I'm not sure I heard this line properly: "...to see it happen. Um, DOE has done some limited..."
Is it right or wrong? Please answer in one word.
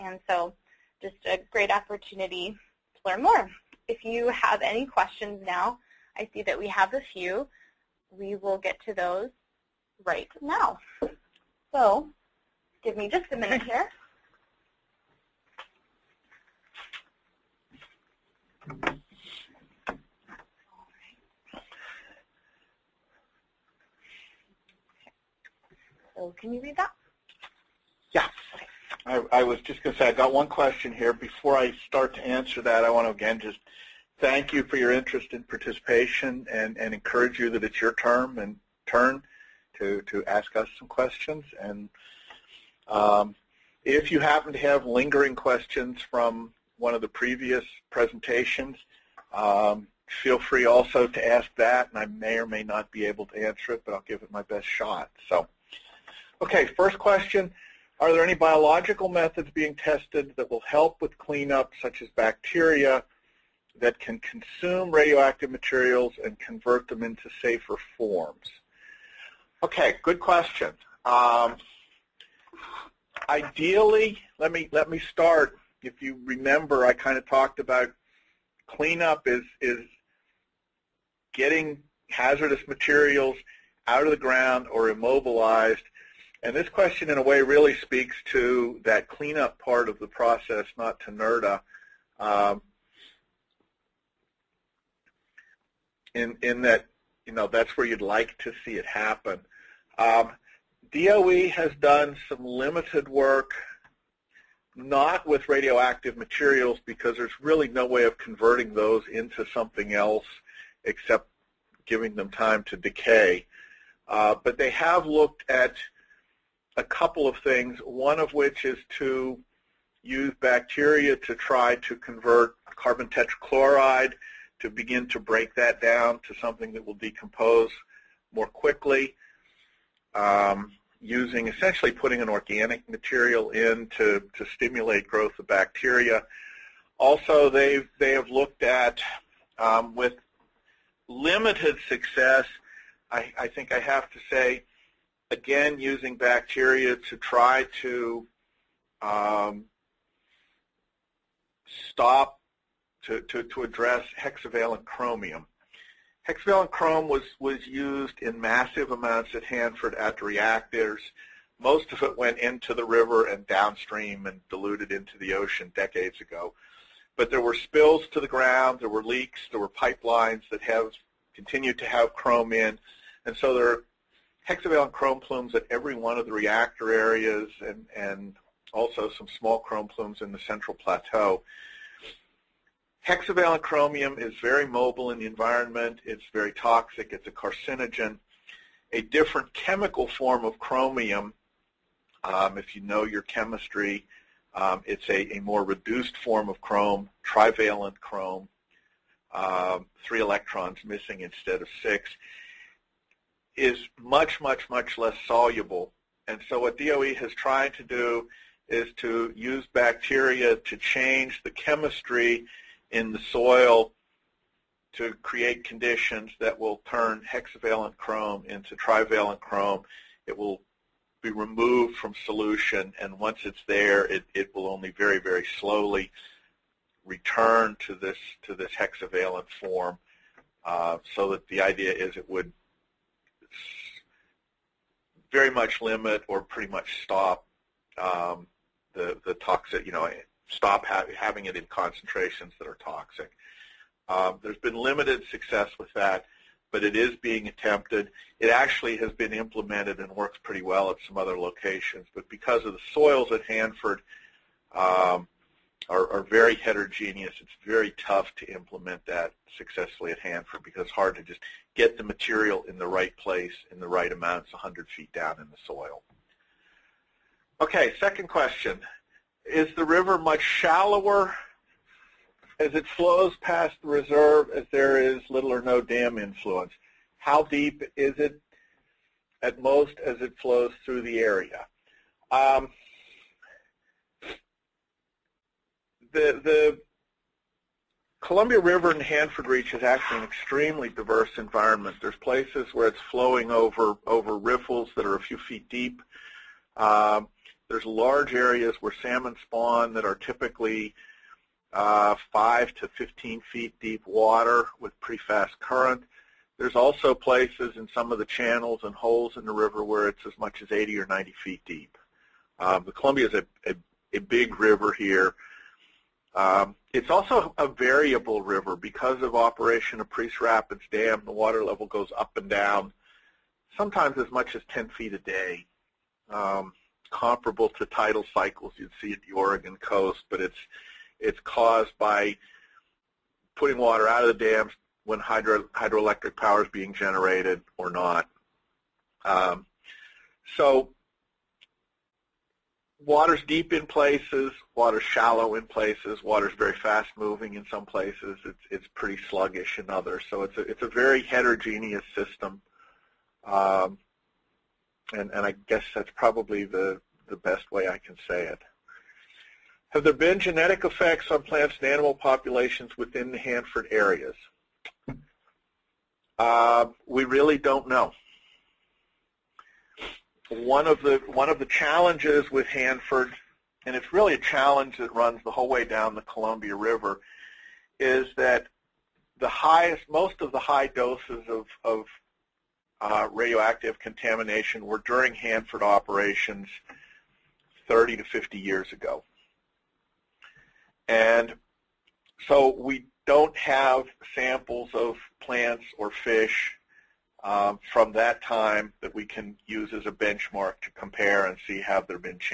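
right.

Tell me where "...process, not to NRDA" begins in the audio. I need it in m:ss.
1:30.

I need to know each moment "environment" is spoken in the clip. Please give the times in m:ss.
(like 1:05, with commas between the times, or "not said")
3:05, 4:51.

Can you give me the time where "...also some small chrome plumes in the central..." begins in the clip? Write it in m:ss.
2:58.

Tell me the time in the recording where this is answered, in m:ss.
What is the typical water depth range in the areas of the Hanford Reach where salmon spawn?
5:02.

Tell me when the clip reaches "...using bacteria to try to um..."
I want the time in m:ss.
2:25.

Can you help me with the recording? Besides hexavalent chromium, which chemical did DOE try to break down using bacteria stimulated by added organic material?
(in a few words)
carbon tetrachloride.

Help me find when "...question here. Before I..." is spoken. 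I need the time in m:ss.
0:30.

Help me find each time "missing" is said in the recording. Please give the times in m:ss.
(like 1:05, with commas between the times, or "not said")
3:20.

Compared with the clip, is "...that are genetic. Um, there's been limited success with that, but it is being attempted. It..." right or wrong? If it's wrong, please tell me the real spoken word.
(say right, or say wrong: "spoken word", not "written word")
wrong: "toxic", not "genetic".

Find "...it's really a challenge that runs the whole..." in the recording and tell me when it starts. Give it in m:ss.
6:13.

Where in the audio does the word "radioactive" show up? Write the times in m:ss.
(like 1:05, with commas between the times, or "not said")
1:04, 1:45, 6:23.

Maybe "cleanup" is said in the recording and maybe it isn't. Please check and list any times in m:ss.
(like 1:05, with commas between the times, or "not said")
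1:01, 1:18, 1:29.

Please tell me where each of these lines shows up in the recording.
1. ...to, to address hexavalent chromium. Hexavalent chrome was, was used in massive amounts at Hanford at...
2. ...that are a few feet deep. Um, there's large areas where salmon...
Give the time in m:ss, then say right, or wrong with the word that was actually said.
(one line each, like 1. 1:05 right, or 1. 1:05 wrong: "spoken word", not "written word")
1. 2:33 right
2. 4:54 right.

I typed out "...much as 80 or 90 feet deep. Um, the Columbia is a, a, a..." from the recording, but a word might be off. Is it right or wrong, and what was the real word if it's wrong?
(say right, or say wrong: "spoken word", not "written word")
right.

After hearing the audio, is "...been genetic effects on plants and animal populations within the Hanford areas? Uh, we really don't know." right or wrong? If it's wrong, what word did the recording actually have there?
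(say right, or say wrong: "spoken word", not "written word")
right.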